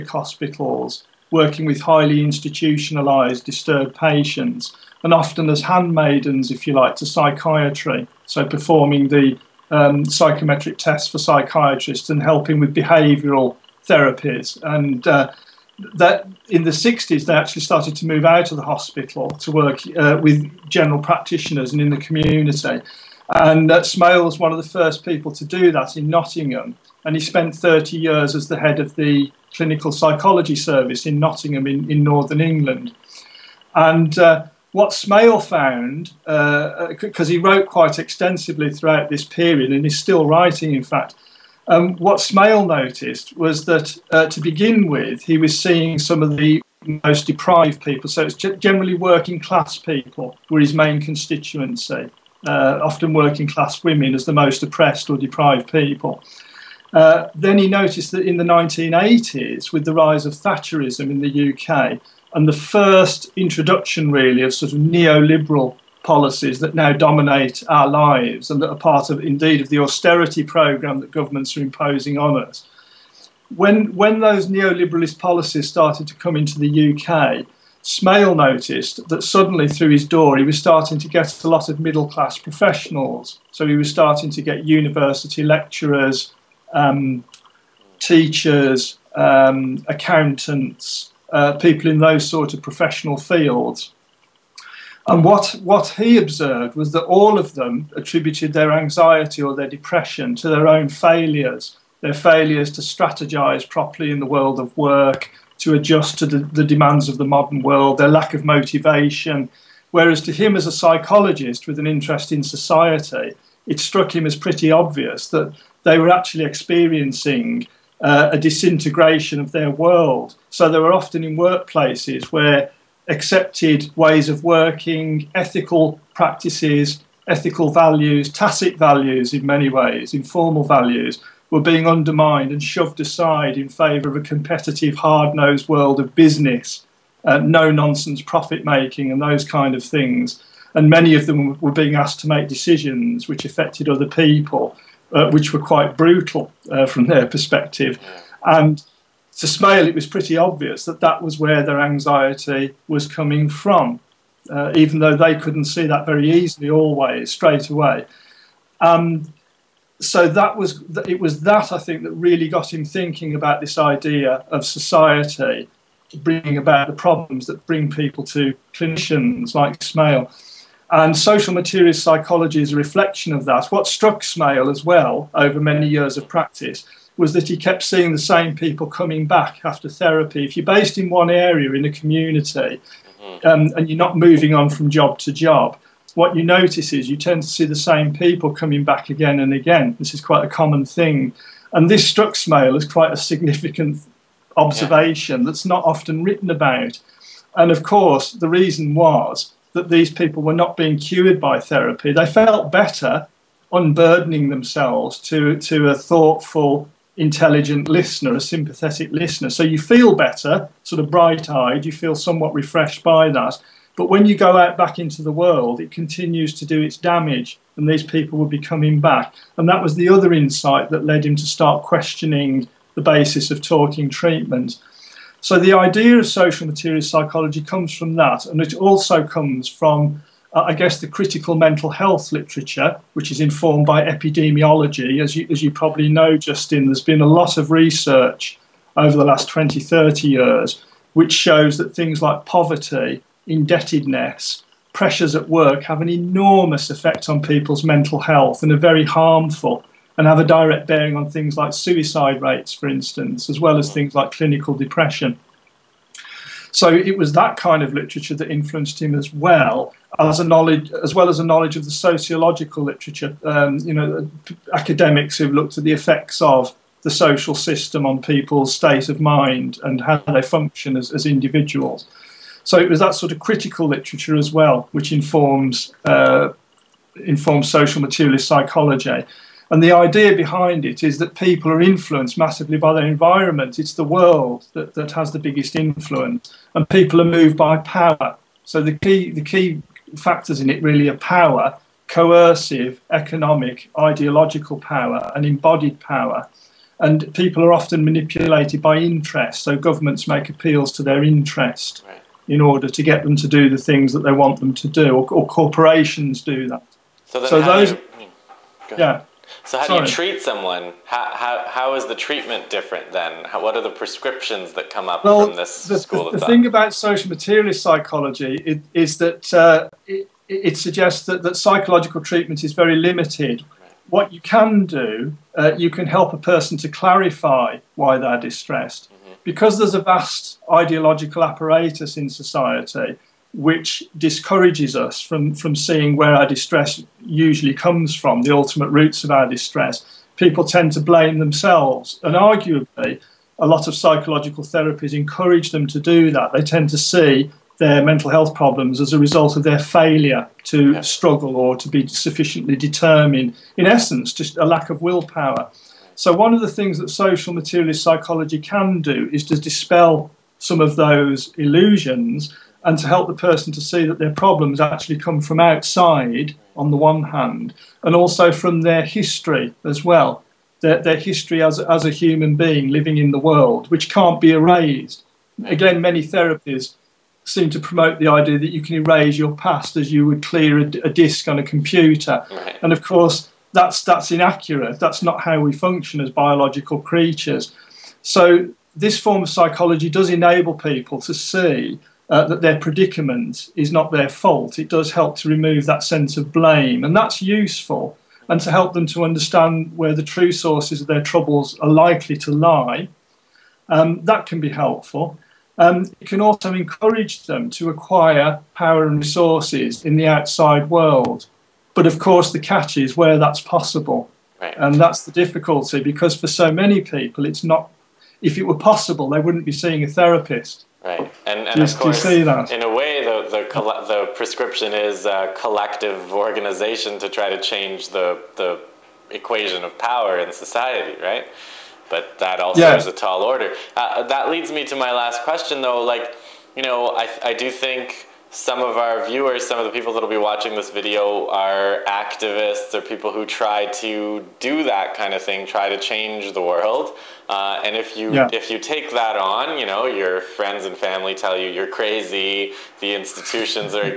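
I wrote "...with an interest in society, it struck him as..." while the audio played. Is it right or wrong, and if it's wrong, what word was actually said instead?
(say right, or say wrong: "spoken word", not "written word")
right.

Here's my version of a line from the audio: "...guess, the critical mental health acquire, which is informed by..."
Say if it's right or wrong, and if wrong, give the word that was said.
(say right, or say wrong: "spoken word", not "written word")
wrong: "literature", not "acquire".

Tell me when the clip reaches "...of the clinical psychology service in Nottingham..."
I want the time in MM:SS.
00:28.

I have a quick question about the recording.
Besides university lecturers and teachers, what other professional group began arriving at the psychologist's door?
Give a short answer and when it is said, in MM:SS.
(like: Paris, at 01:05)
accountants, at 01:29.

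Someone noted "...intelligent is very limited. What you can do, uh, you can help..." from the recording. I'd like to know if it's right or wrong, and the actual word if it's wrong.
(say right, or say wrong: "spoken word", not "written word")
wrong: "treatment", not "intelligent".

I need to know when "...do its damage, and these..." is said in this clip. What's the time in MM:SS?
03:36.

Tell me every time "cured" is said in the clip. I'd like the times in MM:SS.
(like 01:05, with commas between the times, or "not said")
03:20.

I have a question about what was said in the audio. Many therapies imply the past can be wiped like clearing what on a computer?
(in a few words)
a disk.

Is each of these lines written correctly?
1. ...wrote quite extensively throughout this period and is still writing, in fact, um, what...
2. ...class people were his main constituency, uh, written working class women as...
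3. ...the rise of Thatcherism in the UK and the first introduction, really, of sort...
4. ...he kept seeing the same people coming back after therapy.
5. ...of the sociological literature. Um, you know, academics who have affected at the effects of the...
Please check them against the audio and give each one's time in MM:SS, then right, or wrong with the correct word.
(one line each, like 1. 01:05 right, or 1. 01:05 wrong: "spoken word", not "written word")
1. 00:37 right
2. 00:49 wrong: "often", not "written"
3. 00:59 right
4. 02:57 right
5. 04:21 wrong: "looked", not "affected".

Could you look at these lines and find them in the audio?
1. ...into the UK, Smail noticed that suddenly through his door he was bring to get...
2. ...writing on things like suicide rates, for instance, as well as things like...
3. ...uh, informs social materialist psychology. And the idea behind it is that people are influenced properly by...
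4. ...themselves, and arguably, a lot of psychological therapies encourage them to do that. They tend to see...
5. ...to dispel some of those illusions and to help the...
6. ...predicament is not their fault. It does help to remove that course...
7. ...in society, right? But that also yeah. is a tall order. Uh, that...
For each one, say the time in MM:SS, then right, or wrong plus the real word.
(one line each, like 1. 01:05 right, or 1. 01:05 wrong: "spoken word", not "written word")
1. 01:16 wrong: "starting", not "bring"
2. 04:10 wrong: "bearing", not "writing"
3. 04:36 wrong: "massively", not "properly"
4. 05:41 right
5. 05:59 right
6. 06:32 wrong: "sense", not "course"
7. 07:10 right.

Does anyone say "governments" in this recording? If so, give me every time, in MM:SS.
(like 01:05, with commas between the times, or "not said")
01:11, 04:59.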